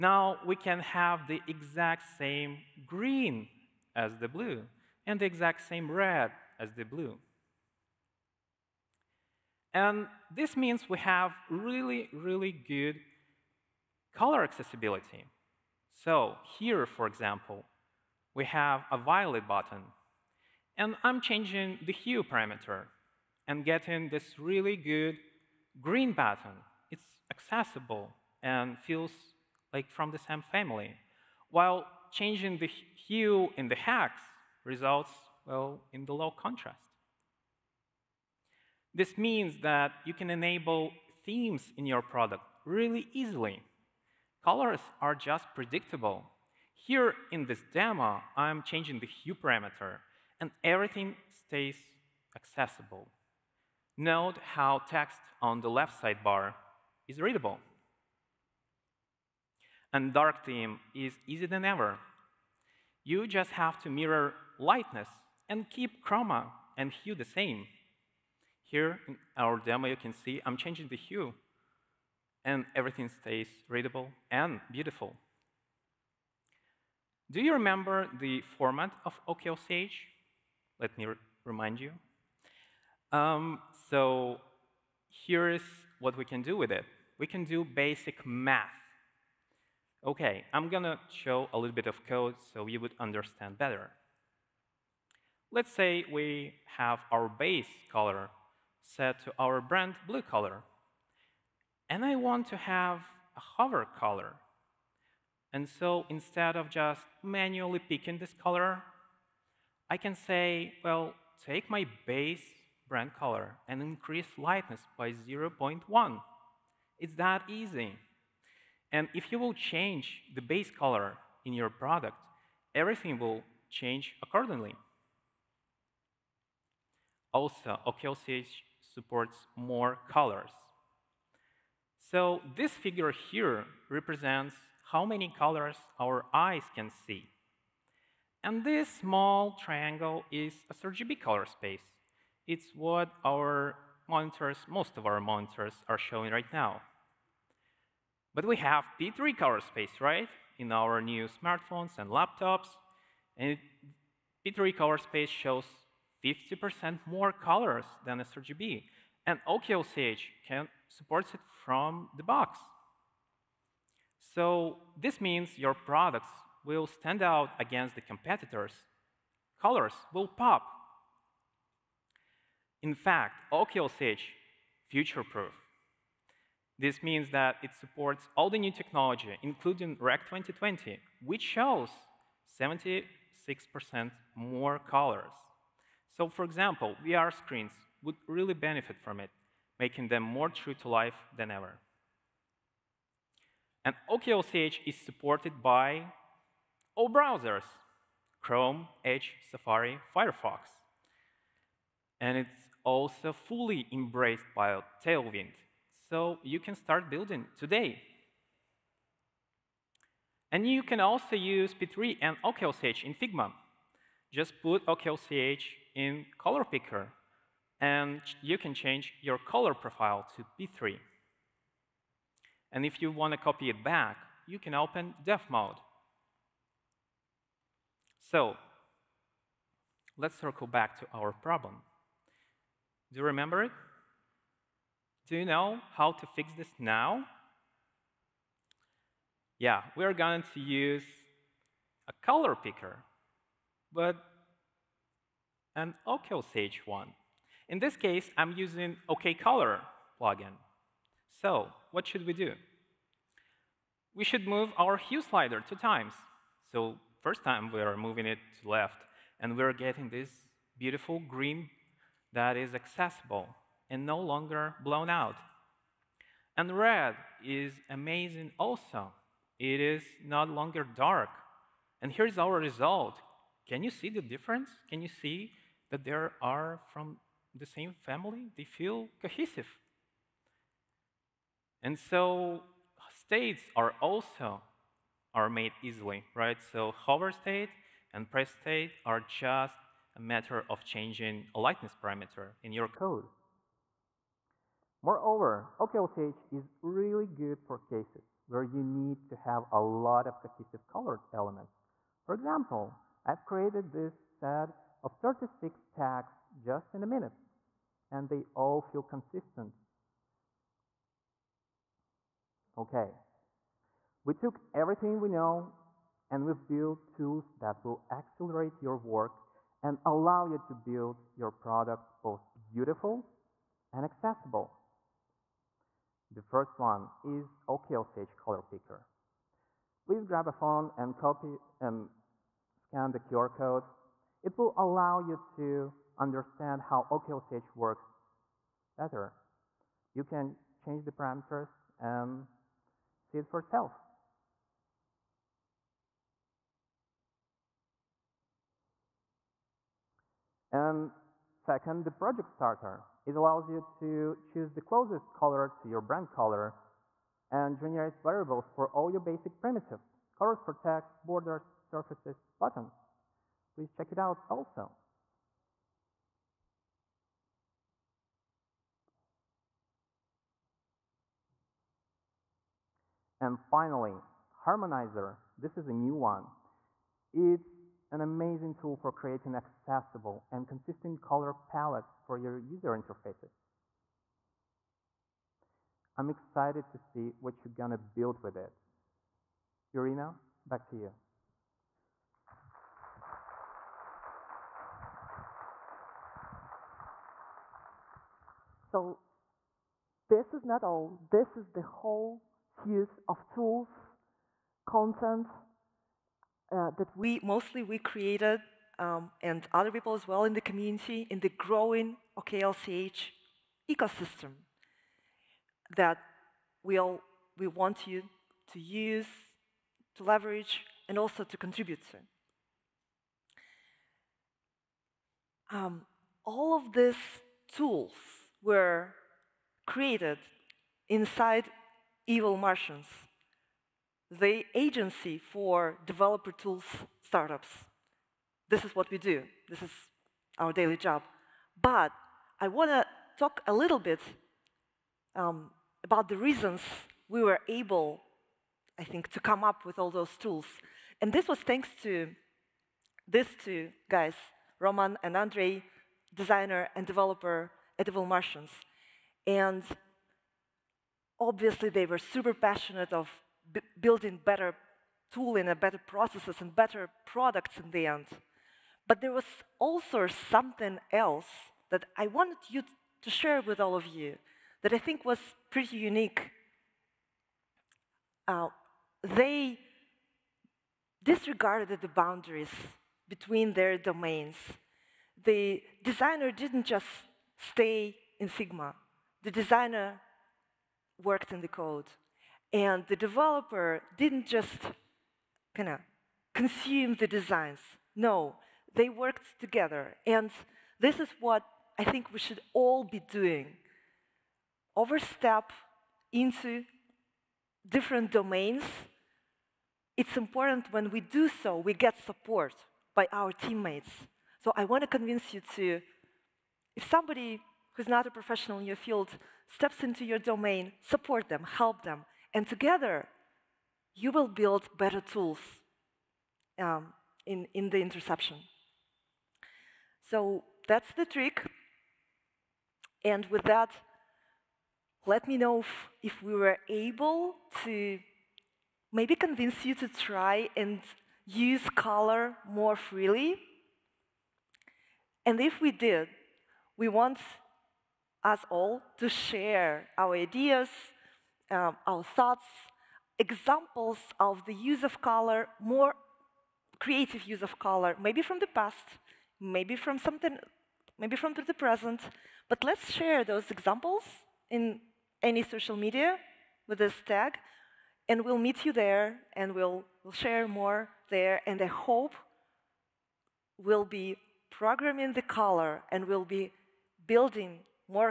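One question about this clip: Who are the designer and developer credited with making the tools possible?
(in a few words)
Roman and Andrei.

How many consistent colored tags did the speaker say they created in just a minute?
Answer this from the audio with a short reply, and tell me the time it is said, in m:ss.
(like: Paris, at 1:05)
36, at 5:05.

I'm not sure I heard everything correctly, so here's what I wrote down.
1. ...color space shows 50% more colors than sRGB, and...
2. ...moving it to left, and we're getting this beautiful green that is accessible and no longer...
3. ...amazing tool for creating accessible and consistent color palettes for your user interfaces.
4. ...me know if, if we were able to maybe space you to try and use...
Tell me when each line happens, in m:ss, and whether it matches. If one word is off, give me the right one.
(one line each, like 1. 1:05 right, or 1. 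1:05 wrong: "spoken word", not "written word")
1. 2:34 right
2. 4:17 right
3. 6:18 right
4. 8:55 wrong: "convince", not "space".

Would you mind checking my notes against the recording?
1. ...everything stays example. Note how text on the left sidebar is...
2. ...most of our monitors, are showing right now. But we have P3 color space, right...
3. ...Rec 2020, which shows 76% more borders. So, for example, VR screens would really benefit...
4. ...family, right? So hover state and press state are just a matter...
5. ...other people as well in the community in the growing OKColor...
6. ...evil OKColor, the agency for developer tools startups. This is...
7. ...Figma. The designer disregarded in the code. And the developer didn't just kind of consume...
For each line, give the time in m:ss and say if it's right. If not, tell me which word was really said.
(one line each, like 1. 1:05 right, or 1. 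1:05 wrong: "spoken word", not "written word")
1. 0:50 wrong: "accessible", not "example"
2. 2:24 right
3. 3:00 wrong: "colors", not "borders"
4. 4:45 wrong: "easily", not "family"
5. 6:49 wrong: "OKLCH", not "OKColor"
6. 7:12 wrong: "Martians", not "OKColor"
7. 8:08 wrong: "worked", not "disregarded".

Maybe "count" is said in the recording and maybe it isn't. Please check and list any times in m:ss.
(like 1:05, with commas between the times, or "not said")
not said.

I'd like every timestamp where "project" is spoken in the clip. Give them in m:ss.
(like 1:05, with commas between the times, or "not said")
5:52.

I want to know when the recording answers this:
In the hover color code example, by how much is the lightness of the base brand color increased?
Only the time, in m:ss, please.
1:55.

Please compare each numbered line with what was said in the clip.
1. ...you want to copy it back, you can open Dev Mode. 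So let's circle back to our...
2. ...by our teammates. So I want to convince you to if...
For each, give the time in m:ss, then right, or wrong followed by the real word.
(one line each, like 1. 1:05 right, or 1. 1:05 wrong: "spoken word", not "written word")
1. 3:43 right
2. 8:33 right.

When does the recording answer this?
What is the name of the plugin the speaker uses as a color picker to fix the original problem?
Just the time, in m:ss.
4:09.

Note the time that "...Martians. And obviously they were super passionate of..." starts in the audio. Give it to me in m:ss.
7:38.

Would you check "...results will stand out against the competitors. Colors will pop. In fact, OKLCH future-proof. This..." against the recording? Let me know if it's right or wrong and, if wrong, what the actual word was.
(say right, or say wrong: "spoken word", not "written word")
wrong: "products", not "results".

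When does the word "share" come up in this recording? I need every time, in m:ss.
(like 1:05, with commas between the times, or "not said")
7:53, 9:09, 9:23, 9:30.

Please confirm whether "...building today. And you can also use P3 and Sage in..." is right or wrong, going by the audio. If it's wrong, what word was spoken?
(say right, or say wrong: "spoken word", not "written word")
wrong: "OKLCH", not "Sage".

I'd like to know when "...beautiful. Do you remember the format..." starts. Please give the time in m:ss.
1:14.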